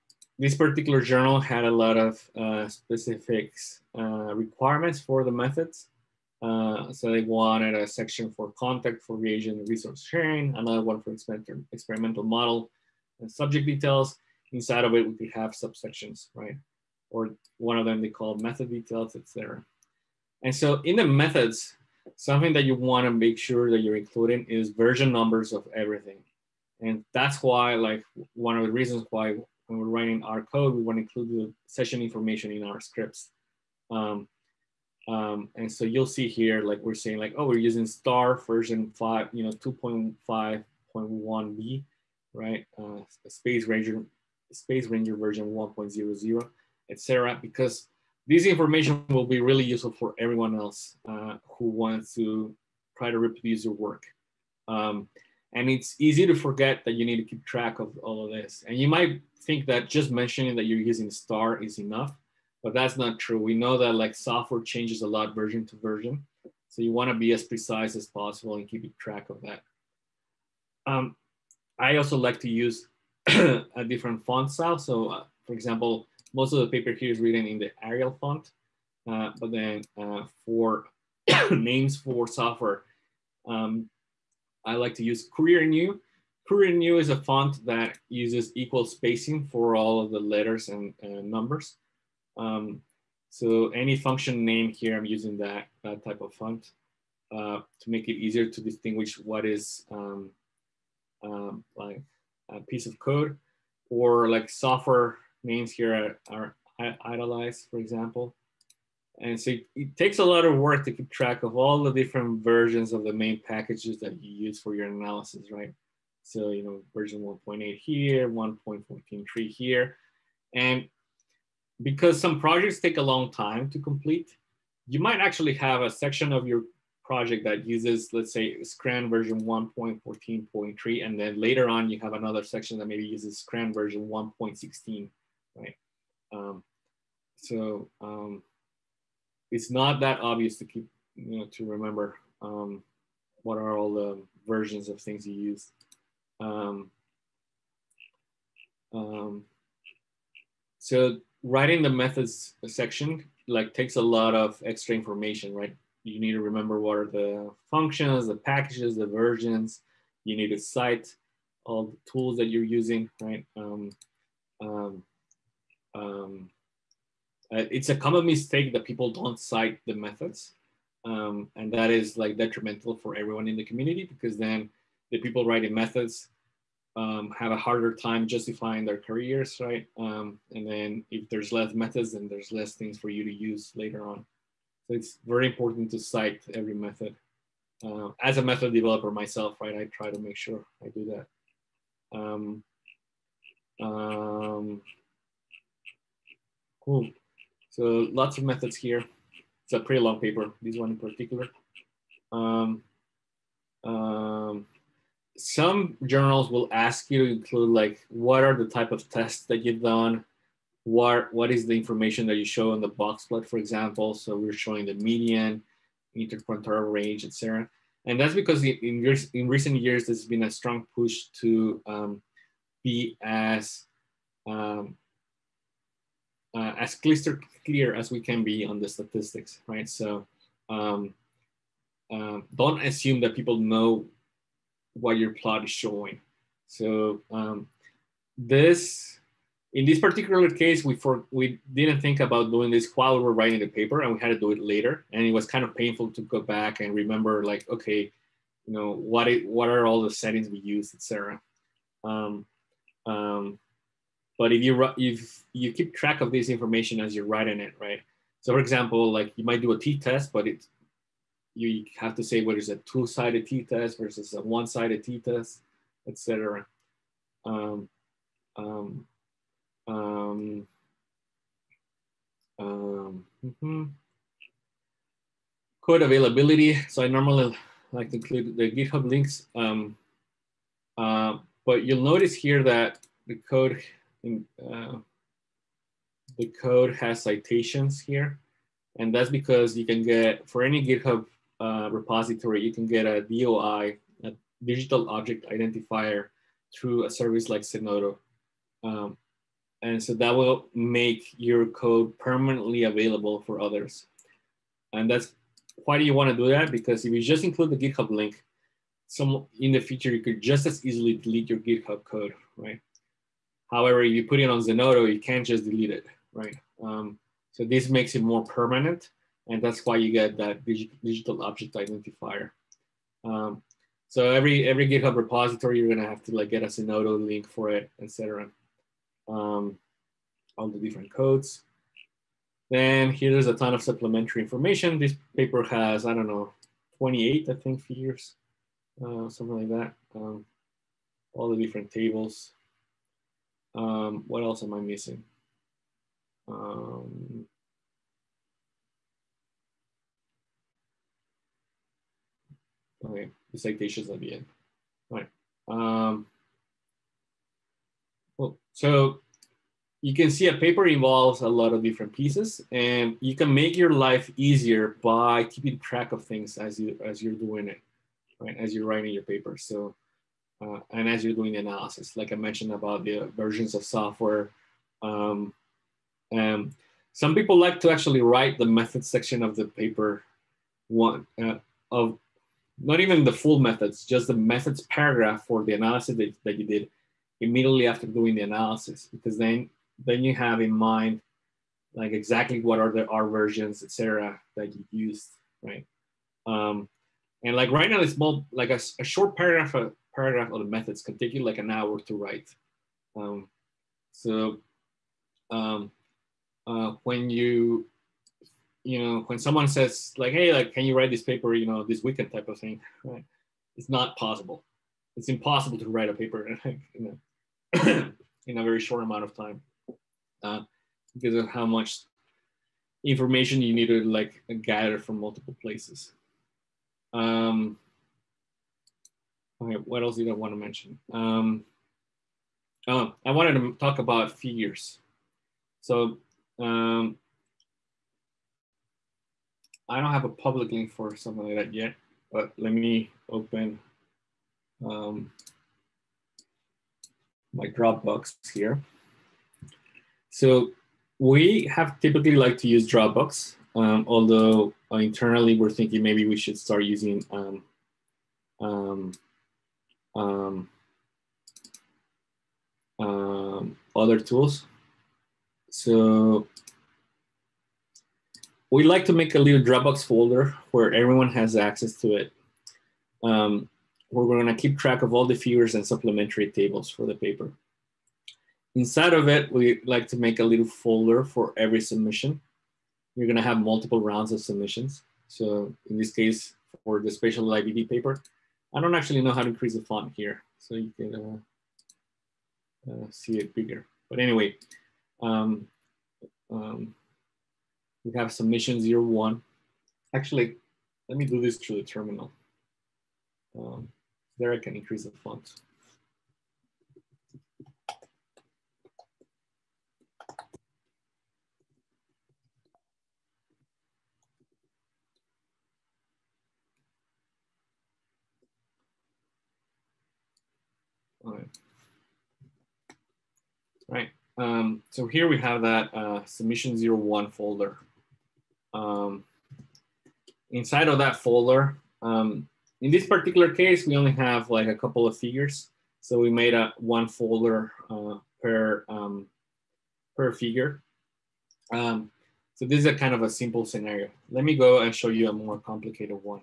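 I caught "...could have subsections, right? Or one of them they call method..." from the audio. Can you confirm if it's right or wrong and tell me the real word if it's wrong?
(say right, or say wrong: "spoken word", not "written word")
right.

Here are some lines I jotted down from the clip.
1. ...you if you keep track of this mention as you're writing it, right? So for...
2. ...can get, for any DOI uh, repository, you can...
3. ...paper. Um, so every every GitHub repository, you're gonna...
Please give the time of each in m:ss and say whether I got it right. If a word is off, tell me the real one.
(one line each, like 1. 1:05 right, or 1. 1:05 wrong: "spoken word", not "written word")
1. 4:14 wrong: "information", not "mention"
2. 4:49 wrong: "GitHub", not "DOI"
3. 5:21 wrong: "identifier", not "paper".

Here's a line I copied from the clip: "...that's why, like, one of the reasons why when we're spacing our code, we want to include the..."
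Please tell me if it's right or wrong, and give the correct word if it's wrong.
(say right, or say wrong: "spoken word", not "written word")
wrong: "writing", not "spacing".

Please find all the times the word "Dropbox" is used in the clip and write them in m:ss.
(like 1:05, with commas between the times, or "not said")
7:27, 7:32, 7:49.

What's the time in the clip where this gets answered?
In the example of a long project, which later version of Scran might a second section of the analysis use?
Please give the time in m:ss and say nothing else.
2:14.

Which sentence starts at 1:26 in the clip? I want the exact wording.
Courier New is a font that uses equal spacing for all of the letters and numbers.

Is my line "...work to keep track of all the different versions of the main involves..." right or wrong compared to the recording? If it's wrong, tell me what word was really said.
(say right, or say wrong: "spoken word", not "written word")
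wrong: "packages", not "involves".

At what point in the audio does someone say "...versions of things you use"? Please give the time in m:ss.
2:24.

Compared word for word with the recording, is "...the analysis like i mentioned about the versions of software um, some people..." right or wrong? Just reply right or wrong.
right.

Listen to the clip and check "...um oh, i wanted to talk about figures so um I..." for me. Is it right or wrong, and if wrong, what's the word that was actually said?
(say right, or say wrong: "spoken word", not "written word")
right.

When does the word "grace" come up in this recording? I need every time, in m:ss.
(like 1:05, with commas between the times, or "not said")
not said.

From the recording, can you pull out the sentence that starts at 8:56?
So we made a one folder uh, per, um, per figure.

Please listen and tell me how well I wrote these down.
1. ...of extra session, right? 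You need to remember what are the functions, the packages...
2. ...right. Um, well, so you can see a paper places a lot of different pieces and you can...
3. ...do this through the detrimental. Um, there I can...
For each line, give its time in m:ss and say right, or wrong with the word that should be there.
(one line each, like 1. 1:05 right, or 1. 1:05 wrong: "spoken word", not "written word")
1. 2:34 wrong: "information", not "session"
2. 5:55 wrong: "involves", not "places"
3. 8:21 wrong: "terminal", not "detrimental".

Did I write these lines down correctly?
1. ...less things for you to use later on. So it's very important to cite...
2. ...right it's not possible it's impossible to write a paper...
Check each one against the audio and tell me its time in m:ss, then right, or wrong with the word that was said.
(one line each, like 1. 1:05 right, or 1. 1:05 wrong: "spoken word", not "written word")
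1. 3:02 right
2. 6:53 right.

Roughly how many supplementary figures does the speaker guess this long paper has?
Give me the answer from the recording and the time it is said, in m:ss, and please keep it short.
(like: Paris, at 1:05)
28, at 5:36.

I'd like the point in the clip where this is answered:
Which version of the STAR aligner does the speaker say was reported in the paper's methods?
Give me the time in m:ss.
0:39.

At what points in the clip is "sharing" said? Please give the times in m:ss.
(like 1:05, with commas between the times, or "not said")
0:10.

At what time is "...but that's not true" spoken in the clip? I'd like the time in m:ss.
1:02.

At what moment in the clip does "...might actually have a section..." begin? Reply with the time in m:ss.
2:05.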